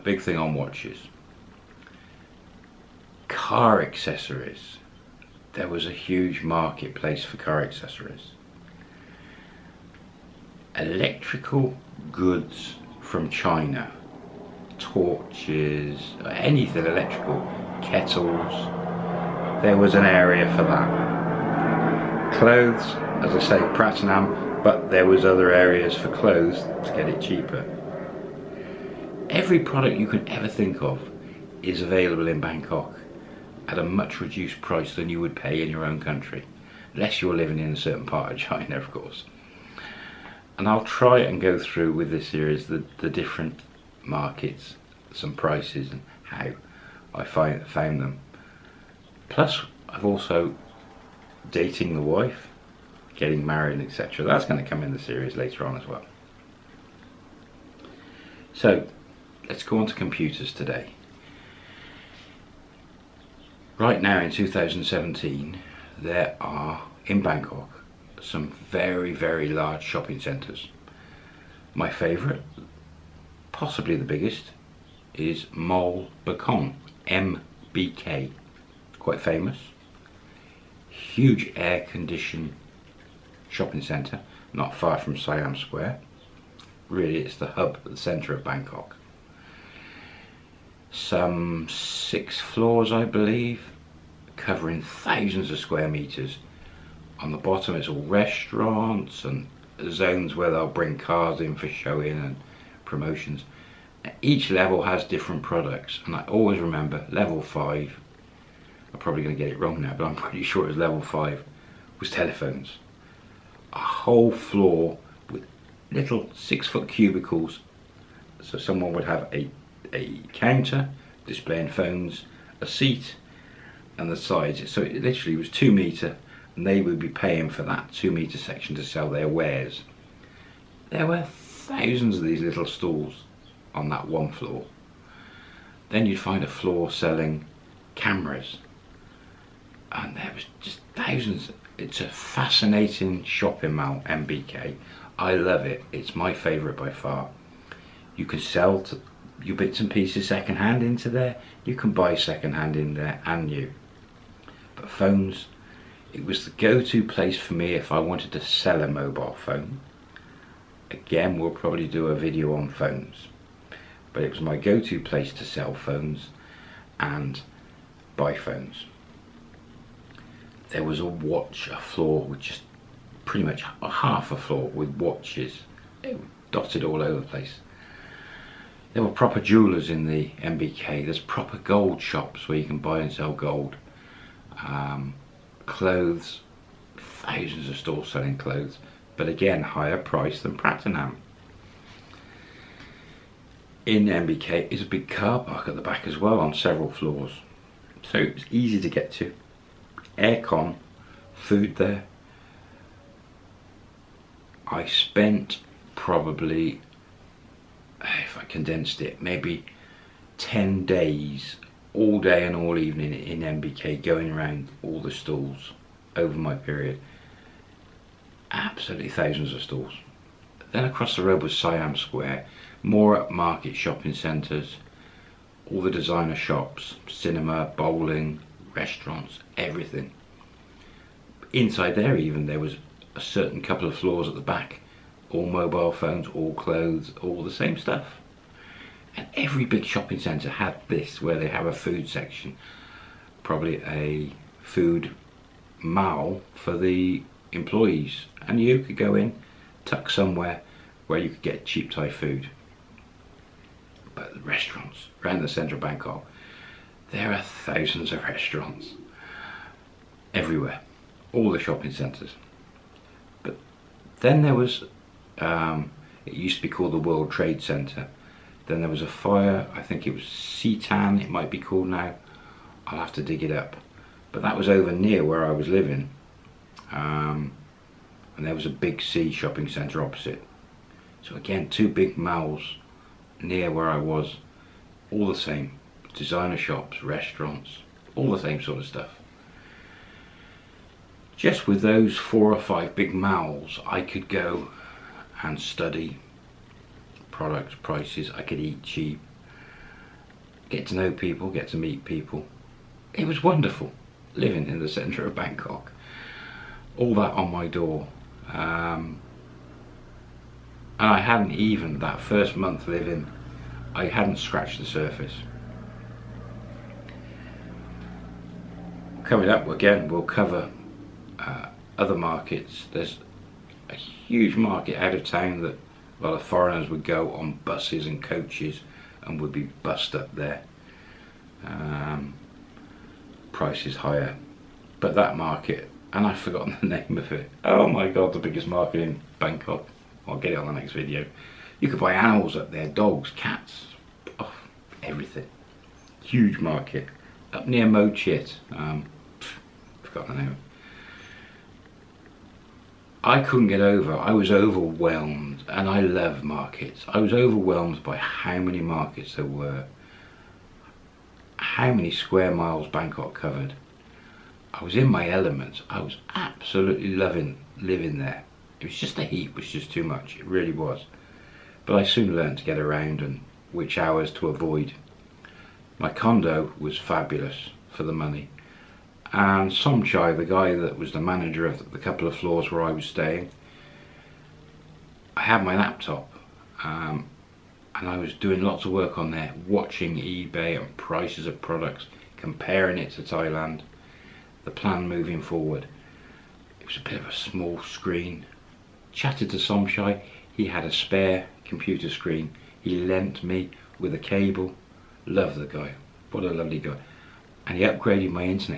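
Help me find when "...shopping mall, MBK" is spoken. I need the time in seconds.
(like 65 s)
143 s.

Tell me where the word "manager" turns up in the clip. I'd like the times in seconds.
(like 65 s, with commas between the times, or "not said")
381 s.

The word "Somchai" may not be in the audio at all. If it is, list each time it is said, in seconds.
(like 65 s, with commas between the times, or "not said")
379 s, 399 s.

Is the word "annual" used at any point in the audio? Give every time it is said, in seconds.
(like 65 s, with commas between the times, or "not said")
not said.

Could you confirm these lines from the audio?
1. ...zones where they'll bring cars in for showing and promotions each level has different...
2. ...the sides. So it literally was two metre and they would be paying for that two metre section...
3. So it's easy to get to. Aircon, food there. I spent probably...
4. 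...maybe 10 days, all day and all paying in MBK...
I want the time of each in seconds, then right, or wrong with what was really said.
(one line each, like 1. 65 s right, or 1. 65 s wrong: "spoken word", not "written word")
1. 99 s right
2. 124 s right
3. 198 s right
4. 209 s wrong: "evening", not "paying".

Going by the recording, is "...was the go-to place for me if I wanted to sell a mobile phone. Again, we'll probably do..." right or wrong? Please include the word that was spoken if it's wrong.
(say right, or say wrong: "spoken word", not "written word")
right.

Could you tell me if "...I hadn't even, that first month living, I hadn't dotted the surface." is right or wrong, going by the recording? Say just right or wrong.
wrong.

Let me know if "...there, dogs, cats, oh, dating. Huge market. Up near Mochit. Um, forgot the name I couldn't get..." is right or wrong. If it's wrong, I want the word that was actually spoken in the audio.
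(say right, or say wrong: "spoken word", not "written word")
wrong: "everything", not "dating".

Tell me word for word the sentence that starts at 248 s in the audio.
And you could go in, tuck somewhere where you could get cheap Thai food.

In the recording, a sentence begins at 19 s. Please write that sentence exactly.
There was an area for that.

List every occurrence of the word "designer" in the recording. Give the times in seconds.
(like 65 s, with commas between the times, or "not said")
225 s, 286 s.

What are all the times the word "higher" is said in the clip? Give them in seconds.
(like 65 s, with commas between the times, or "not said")
189 s, 333 s.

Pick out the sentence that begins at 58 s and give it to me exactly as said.
So, let's go on to computers today.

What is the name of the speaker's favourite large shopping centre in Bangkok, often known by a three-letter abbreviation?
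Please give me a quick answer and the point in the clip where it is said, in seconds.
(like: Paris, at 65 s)
Mall Bakong (MBK), at 75 s.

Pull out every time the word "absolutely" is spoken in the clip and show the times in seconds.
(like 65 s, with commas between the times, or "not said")
218 s, 366 s.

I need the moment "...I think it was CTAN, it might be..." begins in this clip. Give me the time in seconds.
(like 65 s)
269 s.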